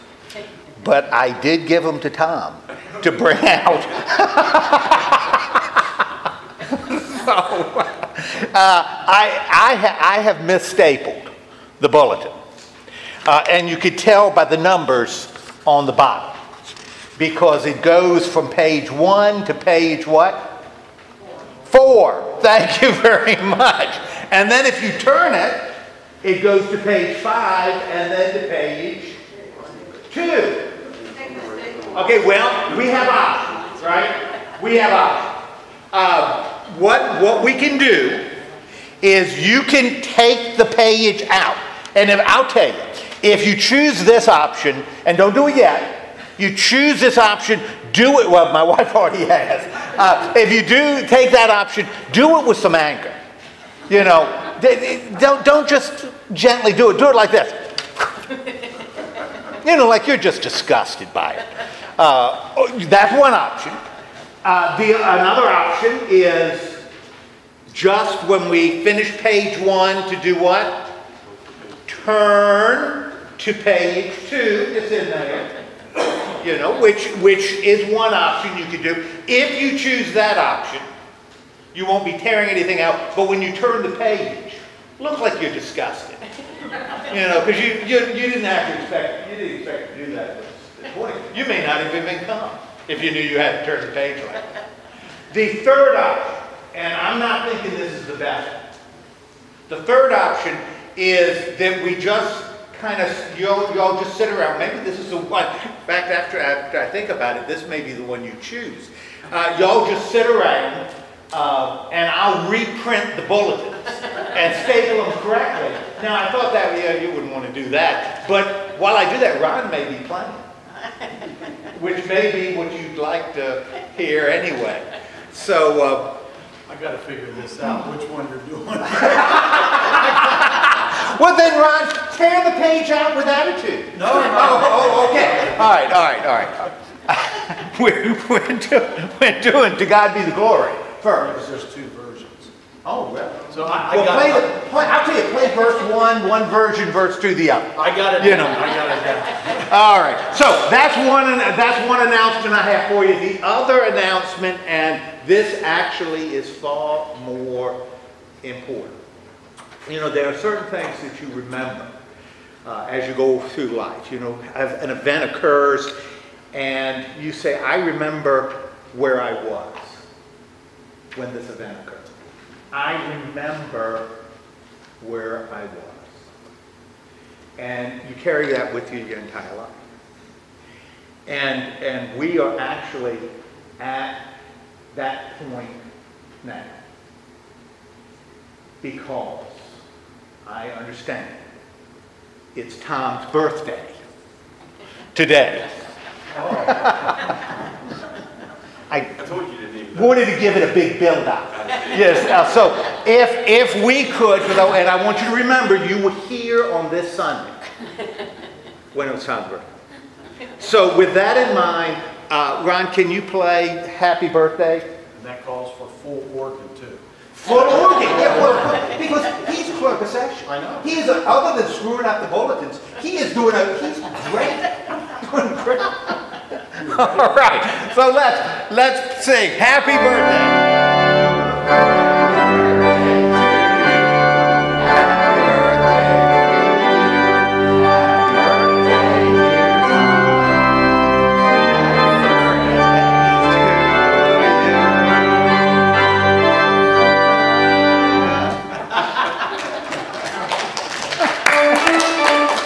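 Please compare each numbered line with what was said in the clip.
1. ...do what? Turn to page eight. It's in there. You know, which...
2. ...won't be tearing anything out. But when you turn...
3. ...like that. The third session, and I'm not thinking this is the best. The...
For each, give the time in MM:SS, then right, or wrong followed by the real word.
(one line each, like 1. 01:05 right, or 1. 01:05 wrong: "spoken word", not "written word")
1. 01:10 wrong: "two", not "eight"
2. 01:21 right
3. 01:34 wrong: "option", not "session".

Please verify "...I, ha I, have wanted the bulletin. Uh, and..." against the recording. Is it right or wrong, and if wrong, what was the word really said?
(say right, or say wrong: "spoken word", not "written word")
wrong: "misstapled", not "wanted".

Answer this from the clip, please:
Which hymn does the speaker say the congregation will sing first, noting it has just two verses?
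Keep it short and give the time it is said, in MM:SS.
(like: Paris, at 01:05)
To God be the Glory, at 02:19.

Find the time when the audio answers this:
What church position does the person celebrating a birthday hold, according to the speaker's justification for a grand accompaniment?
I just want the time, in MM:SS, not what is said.
03:39.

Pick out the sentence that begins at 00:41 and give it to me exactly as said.
And if, I'll tell you, if you choose this option, and don't do it yet, you choose this option, do it.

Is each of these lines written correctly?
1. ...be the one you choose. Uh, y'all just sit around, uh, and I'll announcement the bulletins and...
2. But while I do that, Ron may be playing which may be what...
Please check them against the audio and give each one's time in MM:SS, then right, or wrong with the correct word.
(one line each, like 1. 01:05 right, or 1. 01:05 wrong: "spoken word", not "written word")
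1. 01:47 wrong: "reprint", not "announcement"
2. 01:58 right.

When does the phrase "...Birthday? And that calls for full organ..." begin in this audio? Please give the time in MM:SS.
03:34.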